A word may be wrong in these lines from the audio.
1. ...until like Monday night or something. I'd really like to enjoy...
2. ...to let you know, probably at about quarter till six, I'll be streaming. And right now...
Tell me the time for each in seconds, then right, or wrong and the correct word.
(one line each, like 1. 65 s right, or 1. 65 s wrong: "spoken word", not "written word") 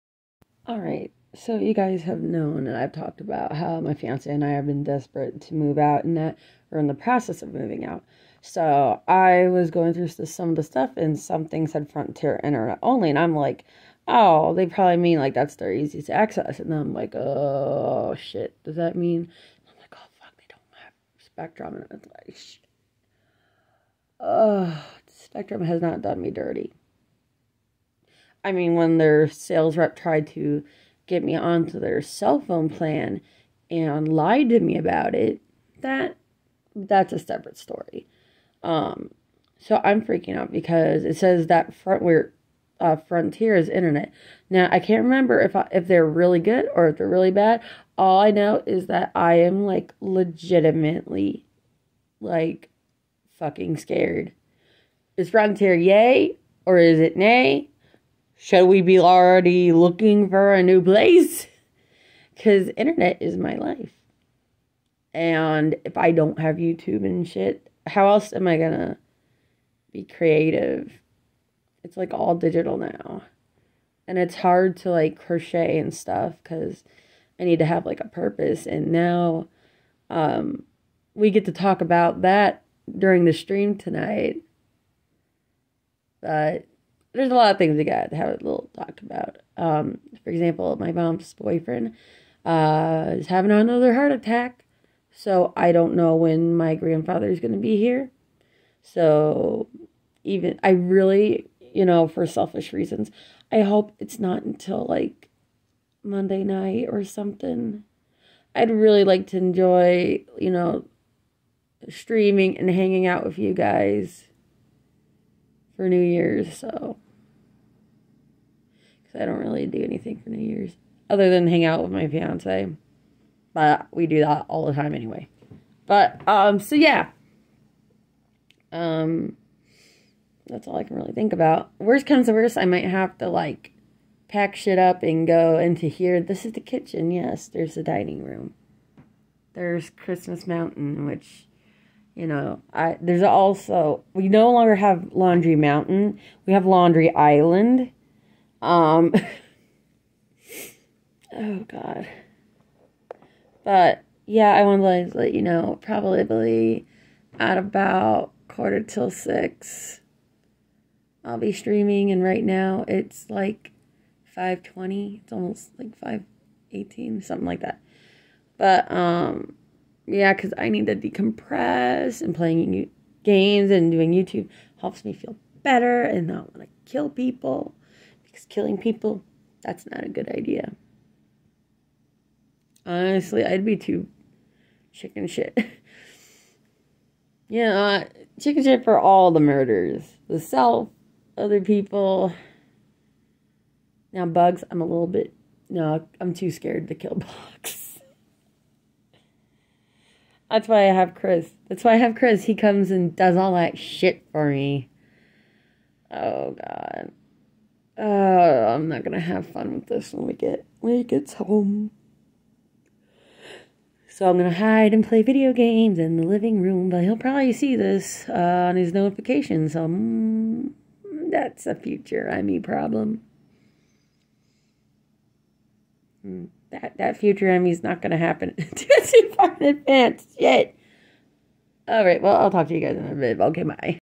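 1. 104 s right
2. 155 s right.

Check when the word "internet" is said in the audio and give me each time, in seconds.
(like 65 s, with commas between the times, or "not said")
12 s, 43 s, 62 s.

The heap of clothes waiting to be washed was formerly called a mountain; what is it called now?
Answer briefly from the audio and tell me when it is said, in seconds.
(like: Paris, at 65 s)
Laundry Island, at 146 s.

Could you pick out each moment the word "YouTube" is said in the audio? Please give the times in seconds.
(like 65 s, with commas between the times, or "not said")
66 s, 174 s.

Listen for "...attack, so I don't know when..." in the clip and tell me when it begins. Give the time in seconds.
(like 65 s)
94 s.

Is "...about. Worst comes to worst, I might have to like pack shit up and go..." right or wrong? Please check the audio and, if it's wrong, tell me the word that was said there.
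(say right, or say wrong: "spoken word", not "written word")
right.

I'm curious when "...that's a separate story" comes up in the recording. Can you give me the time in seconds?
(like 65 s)
36 s.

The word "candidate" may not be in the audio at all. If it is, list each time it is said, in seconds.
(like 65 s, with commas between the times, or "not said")
not said.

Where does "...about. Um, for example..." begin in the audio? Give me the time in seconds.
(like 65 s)
89 s.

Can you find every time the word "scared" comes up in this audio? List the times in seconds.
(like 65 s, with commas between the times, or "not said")
53 s, 196 s.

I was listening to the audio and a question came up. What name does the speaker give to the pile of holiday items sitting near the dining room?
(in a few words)
Christmas Mountain.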